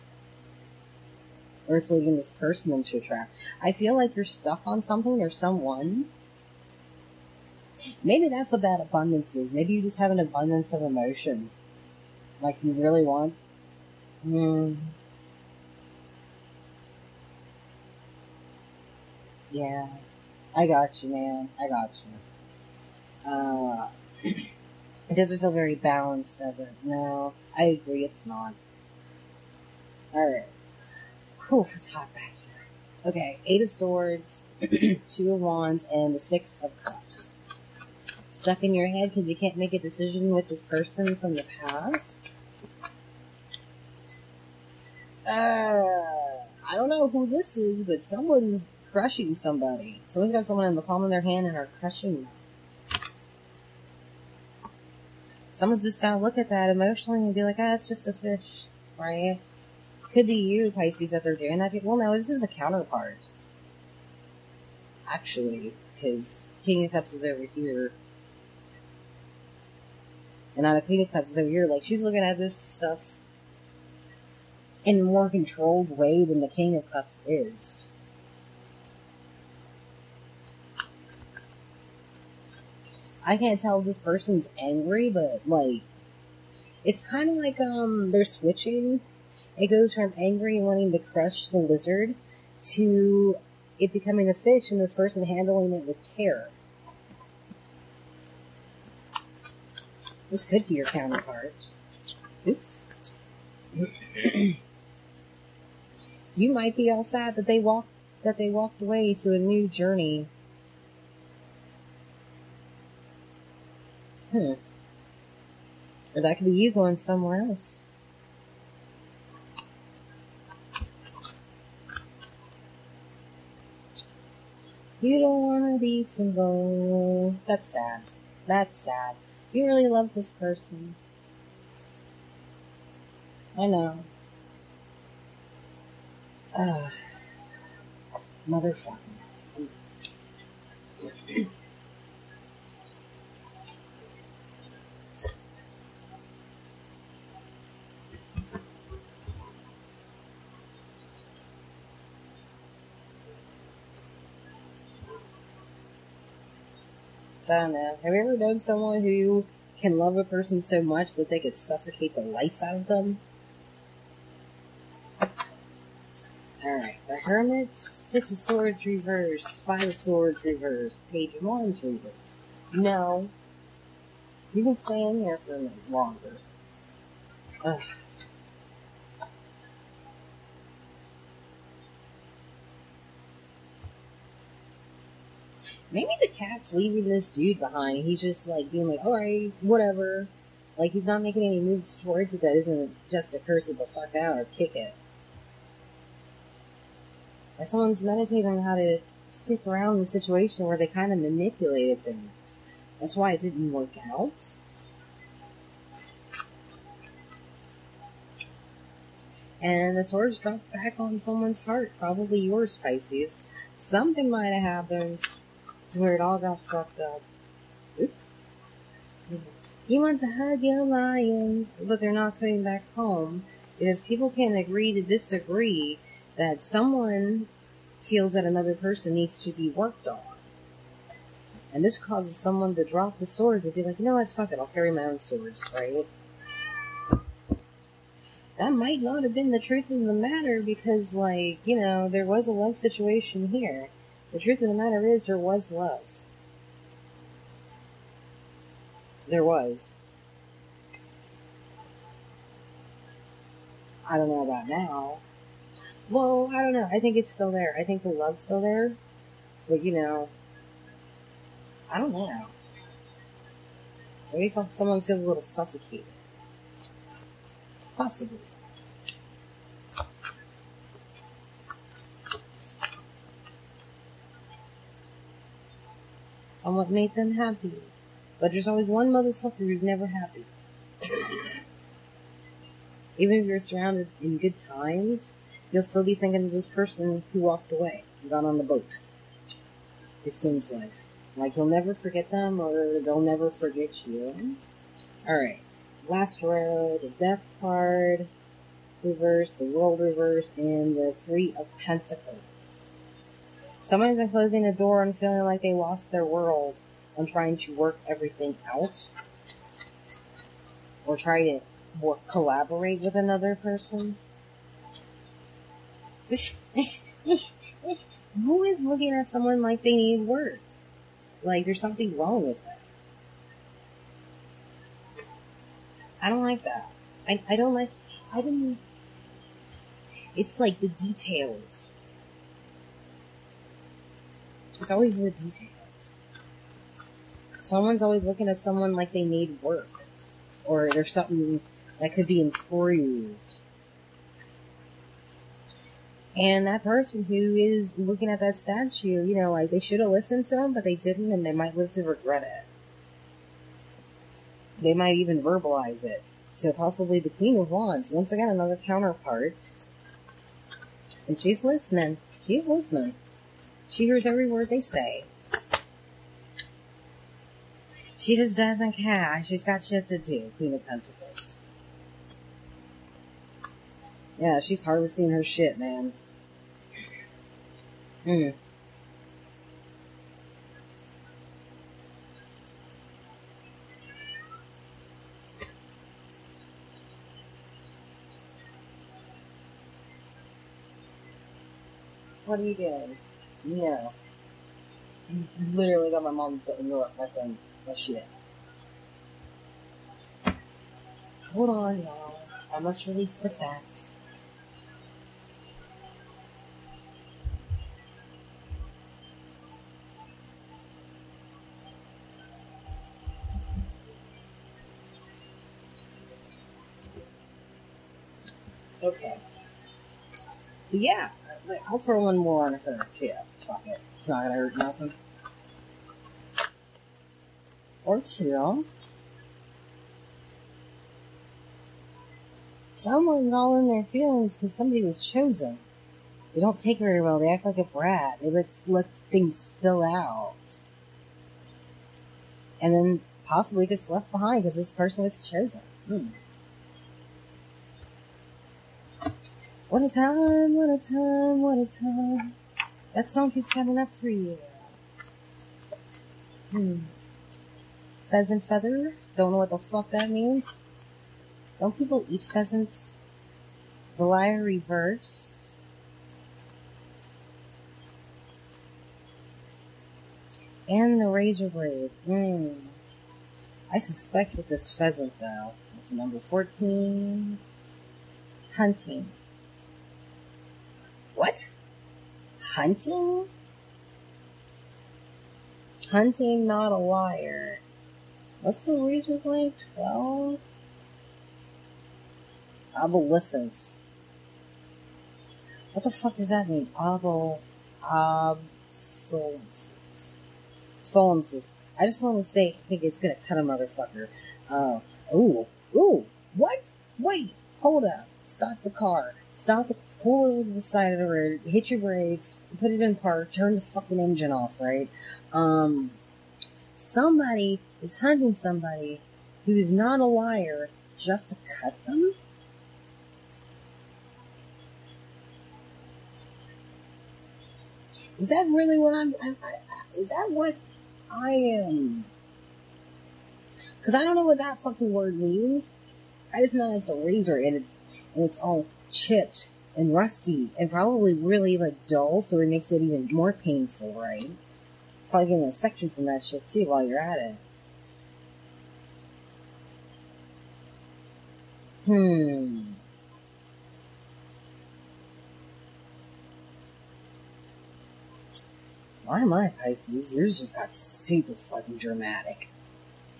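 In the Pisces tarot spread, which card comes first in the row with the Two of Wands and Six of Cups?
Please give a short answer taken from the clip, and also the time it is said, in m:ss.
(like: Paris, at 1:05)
Eight of Swords, at 0:33.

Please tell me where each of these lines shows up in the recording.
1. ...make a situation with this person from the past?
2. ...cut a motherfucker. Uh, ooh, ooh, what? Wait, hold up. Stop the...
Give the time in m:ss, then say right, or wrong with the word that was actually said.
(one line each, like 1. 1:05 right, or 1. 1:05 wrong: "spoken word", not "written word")
1. 0:39 wrong: "decision", not "situation"
2. 8:23 right.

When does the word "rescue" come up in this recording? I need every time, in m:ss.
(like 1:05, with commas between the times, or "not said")
not said.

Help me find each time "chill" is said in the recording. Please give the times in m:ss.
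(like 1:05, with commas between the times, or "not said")
7:08.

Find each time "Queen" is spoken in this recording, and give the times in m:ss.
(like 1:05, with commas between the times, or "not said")
1:10, 5:57, 6:10.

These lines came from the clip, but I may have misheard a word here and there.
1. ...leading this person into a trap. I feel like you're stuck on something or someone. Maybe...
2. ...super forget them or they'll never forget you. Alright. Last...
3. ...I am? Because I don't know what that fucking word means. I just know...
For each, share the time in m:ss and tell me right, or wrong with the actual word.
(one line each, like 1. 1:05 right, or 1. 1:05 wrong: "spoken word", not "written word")
1. 0:01 right
2. 4:51 wrong: "never", not "super"
3. 8:51 right.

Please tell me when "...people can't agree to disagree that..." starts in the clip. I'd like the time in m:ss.
3:43.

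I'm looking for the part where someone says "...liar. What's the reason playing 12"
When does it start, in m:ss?
8:06.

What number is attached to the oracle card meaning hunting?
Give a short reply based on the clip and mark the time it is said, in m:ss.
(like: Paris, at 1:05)
14, at 7:56.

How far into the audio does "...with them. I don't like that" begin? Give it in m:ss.
5:22.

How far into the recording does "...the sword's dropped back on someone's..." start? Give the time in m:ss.
3:29.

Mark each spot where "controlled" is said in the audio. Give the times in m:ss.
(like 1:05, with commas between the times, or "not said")
1:15.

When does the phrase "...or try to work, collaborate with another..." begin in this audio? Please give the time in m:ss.
5:11.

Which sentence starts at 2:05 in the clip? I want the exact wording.
You don't want to be single.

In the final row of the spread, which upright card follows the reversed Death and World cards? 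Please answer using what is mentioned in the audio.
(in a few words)
Three of Pentacles.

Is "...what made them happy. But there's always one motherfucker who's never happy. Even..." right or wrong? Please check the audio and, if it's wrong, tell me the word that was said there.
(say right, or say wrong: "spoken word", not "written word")
right.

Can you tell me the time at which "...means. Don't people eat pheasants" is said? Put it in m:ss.
7:40.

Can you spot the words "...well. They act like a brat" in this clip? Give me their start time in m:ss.
7:17.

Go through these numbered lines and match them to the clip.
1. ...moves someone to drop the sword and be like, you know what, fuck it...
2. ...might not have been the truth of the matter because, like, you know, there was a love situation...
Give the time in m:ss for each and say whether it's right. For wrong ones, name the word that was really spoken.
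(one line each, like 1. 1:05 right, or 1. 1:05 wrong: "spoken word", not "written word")
1. 3:51 wrong: "causes", not "moves"
2. 3:58 right.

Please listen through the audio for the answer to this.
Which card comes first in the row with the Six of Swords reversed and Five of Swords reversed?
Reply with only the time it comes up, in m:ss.
2:47.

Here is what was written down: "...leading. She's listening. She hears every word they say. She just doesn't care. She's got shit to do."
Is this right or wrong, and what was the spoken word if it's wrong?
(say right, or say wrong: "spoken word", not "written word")
wrong: "listening", not "leading".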